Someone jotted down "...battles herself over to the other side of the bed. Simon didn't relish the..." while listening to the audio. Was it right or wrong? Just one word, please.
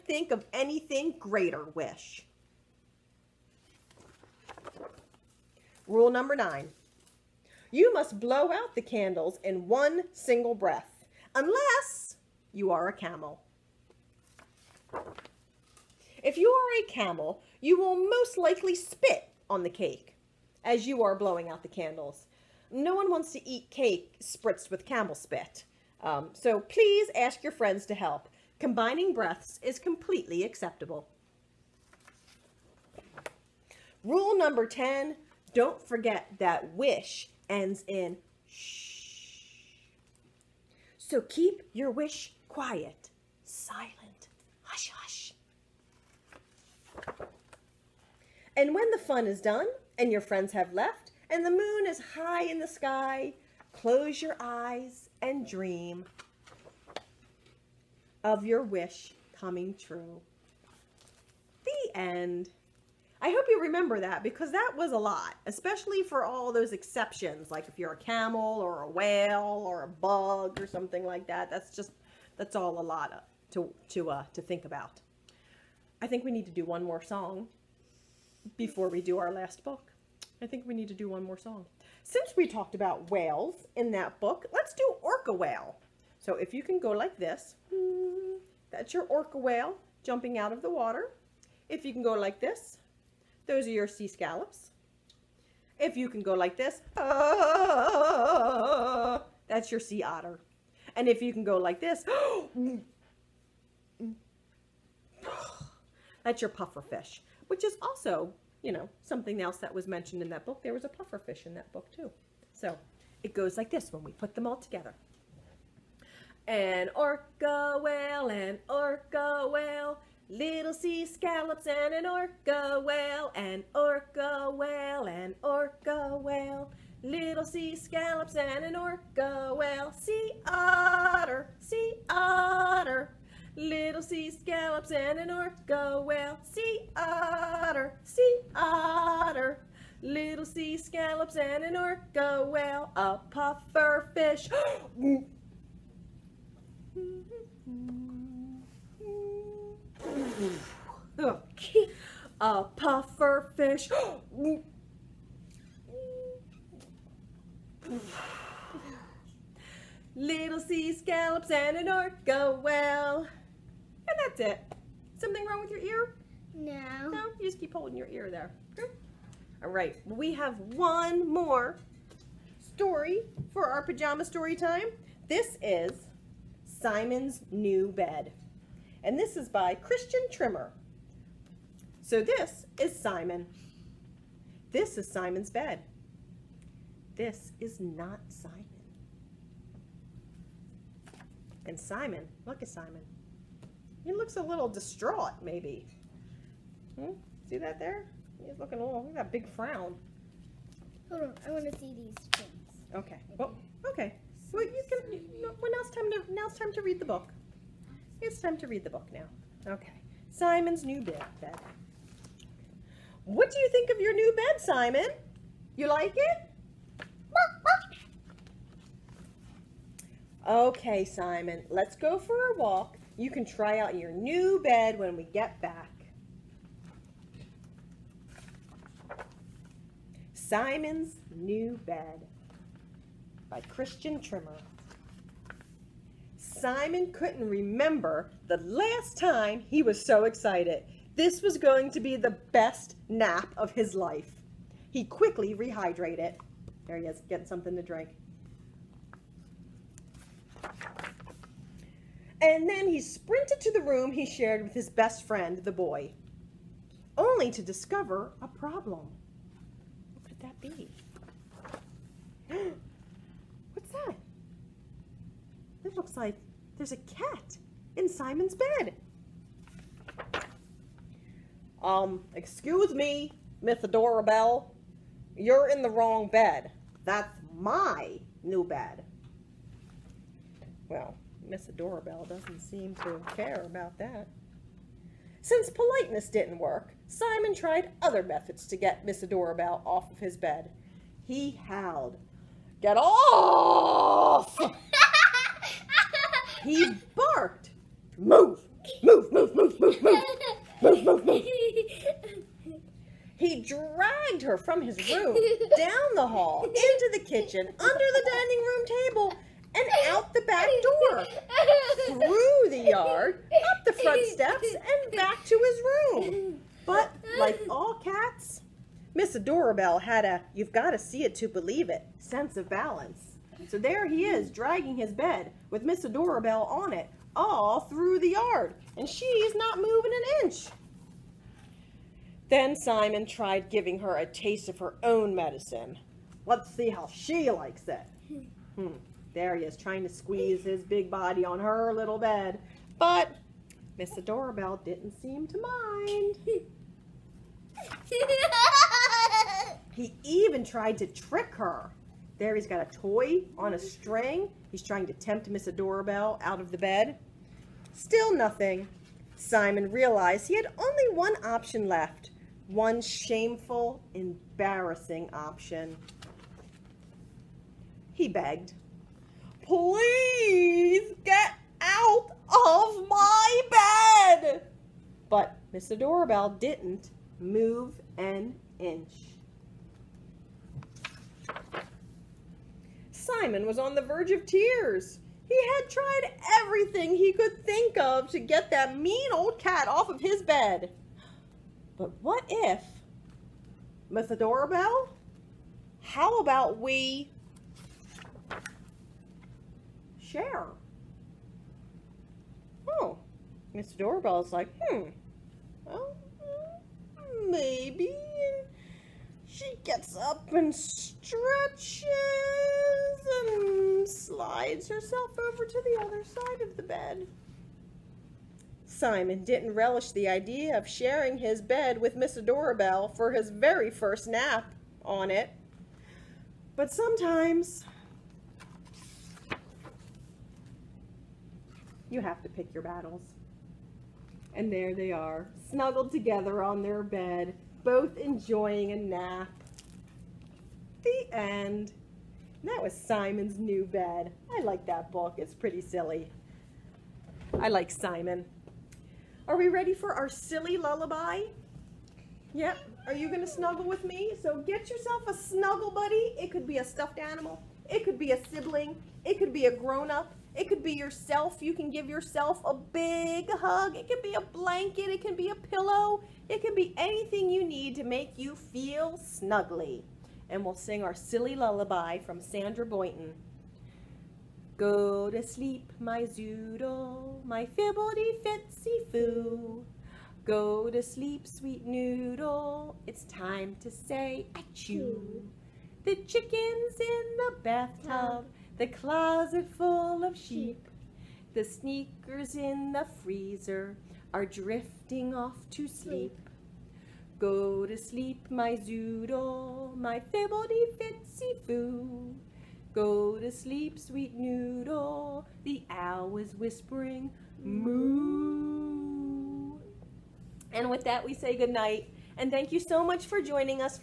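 wrong.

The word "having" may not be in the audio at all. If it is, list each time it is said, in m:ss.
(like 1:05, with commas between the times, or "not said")
not said.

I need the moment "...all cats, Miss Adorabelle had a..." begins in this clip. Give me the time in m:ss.
5:17.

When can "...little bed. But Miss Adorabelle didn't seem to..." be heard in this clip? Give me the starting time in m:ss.
5:41.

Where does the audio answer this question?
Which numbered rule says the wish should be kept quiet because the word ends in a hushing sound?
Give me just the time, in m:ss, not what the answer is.
0:34.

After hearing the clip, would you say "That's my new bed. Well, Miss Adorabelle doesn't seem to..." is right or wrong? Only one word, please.
right.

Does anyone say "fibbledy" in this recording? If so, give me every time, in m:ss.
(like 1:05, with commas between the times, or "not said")
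7:57, 8:20.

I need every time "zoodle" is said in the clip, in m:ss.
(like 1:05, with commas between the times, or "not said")
7:56, 8:18.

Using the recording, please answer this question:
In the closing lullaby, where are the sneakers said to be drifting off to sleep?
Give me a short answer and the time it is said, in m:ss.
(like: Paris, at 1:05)
the freezer, at 8:13.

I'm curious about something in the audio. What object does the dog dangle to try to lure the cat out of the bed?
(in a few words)
toy on a string.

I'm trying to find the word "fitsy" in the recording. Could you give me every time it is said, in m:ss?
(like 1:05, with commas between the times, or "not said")
7:57, 8:20.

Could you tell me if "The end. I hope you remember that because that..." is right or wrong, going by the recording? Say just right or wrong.
right.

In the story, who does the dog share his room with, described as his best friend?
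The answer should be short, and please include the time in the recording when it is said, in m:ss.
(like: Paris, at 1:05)
the boy, at 4:15.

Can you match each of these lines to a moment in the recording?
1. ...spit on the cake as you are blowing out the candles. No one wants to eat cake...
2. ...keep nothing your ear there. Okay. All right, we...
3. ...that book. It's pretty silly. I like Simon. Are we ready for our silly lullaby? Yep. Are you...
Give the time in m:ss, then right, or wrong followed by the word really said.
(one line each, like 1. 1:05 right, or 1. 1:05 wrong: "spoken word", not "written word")
1. 0:18 right
2. 2:47 wrong: "holding", not "nothing"
3. 7:24 right.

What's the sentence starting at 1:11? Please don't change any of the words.
That's just, that's all a lot to, to, uh, to think about.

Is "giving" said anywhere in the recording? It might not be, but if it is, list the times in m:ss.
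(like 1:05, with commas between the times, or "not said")
5:33.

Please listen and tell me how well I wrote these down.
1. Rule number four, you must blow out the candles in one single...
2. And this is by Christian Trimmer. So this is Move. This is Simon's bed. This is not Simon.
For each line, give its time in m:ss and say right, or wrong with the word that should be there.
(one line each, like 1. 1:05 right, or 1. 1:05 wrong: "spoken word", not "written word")
1. 0:05 wrong: "nine", not "four"
2. 2:59 wrong: "Simon", not "Move".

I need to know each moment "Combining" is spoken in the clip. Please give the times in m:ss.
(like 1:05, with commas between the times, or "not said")
0:28.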